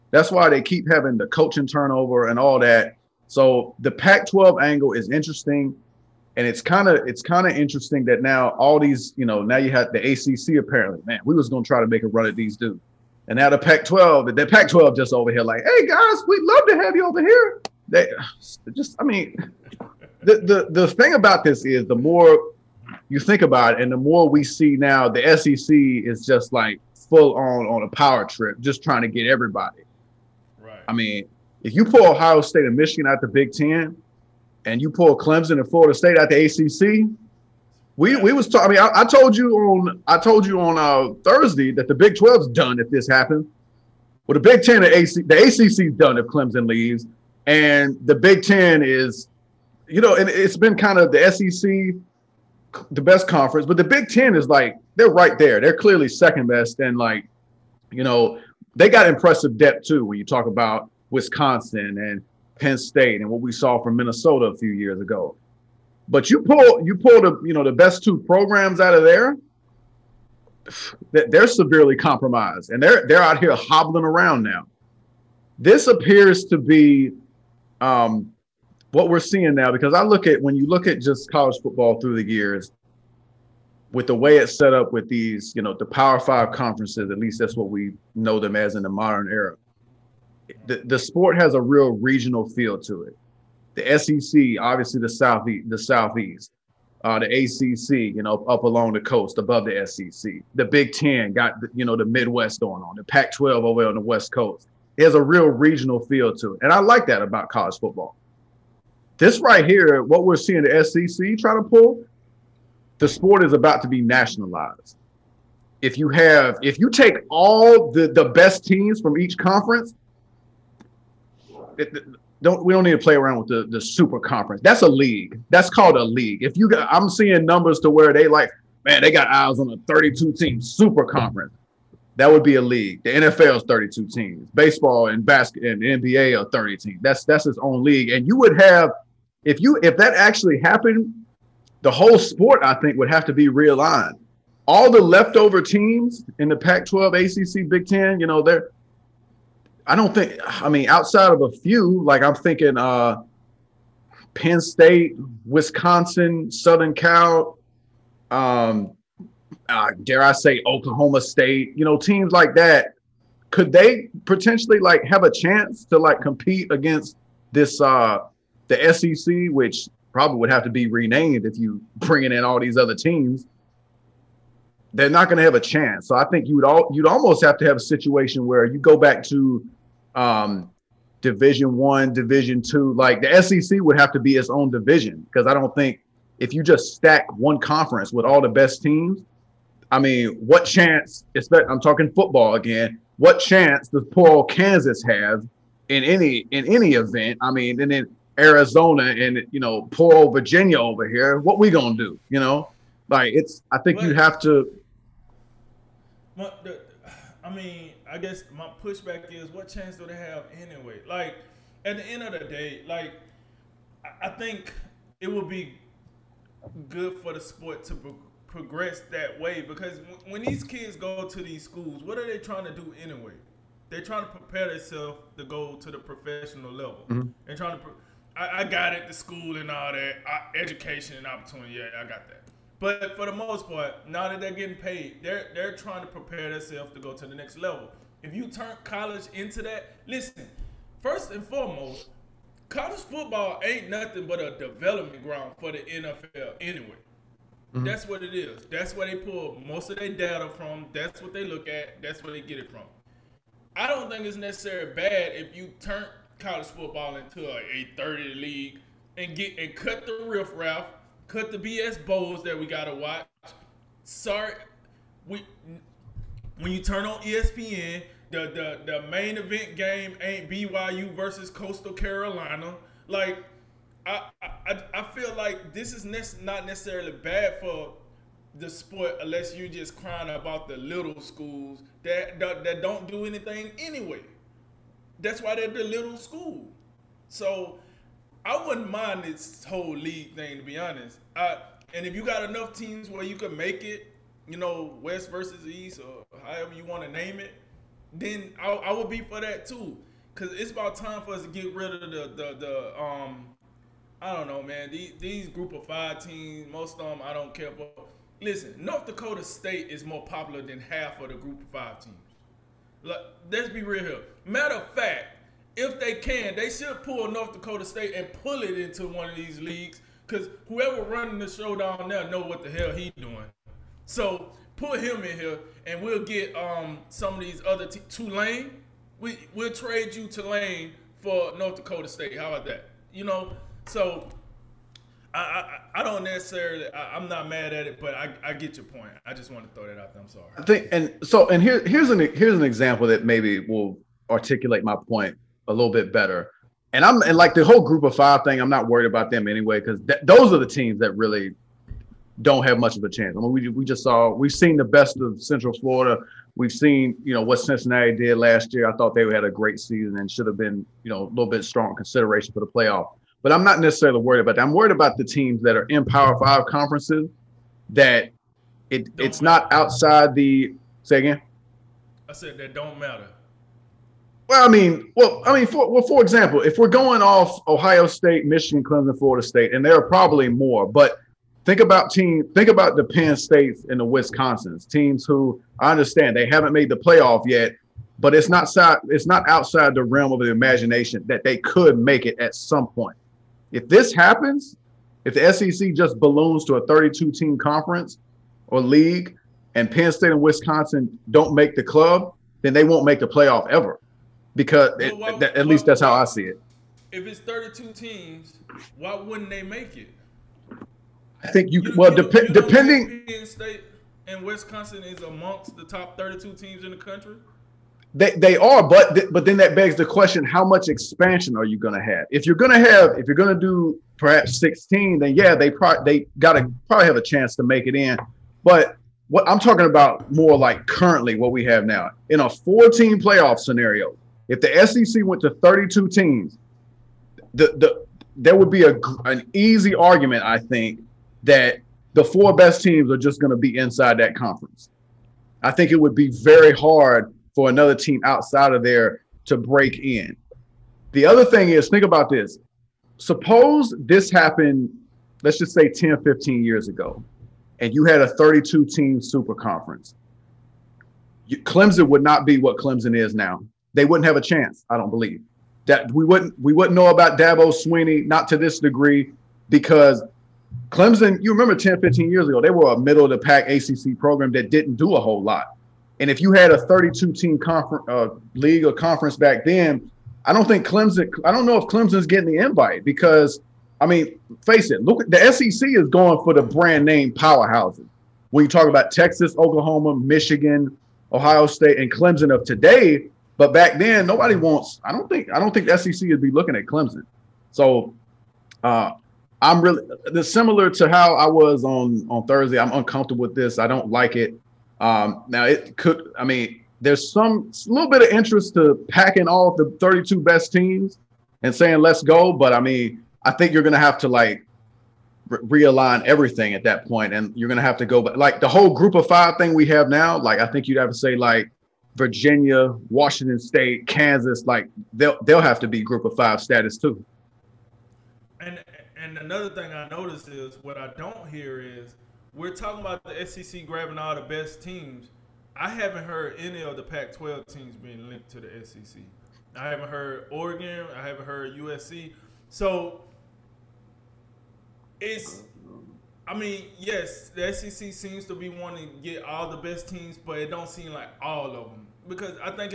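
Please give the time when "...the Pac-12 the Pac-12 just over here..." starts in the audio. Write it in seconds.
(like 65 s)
13 s.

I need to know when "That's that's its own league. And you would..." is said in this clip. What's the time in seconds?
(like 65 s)
137 s.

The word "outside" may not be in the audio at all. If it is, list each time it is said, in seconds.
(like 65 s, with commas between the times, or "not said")
150 s, 369 s, 389 s, 448 s.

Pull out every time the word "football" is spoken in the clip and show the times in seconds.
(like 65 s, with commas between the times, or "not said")
81 s, 107 s, 192 s, 243 s, 256 s.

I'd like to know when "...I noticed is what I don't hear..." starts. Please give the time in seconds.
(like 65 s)
529 s.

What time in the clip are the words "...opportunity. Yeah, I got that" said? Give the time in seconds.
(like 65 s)
231 s.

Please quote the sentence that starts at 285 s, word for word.
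That's why they're the little school.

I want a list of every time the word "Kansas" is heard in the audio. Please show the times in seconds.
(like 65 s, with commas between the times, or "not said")
194 s, 524 s.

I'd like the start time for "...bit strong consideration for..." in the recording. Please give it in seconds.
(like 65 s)
361 s.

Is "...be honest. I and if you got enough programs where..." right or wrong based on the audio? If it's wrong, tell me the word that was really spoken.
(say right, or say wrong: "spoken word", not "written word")
wrong: "teams", not "programs".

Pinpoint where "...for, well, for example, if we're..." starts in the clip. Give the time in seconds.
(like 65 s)
375 s.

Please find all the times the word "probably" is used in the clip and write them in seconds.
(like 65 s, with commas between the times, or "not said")
170 s, 380 s, 426 s.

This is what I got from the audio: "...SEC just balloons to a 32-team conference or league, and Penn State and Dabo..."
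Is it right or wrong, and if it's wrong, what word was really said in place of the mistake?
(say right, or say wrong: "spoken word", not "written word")
wrong: "Wisconsin", not "Dabo".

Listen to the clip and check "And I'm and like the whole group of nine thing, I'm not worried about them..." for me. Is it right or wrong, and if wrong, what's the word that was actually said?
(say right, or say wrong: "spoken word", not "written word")
wrong: "five", not "nine".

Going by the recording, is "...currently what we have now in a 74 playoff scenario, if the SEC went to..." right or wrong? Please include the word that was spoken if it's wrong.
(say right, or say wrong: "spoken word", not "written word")
wrong: "14", not "74".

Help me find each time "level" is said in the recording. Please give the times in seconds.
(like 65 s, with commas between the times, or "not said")
226 s, 237 s.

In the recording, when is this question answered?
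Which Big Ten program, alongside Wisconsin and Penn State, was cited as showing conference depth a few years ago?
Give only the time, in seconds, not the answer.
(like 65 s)
63 s.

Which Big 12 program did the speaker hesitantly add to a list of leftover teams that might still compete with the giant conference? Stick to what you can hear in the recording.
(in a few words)
Oklahoma State.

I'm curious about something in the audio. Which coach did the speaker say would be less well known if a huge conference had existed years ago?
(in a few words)
Dabo Swinney.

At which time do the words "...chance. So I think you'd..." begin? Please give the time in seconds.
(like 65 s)
175 s.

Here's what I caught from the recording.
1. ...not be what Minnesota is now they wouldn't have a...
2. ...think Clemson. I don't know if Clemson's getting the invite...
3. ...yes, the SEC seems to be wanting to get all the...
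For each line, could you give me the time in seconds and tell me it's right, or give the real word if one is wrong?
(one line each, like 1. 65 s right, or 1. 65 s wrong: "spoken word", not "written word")
1. 462 s wrong: "Clemson", not "Minnesota"
2. 480 s right
3. 546 s right.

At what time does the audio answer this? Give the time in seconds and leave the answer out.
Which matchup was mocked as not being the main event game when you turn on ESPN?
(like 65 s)
270 s.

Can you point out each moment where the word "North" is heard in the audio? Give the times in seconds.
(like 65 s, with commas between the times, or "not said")
308 s, 317 s, 331 s.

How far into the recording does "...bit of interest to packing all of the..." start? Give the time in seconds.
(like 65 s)
508 s.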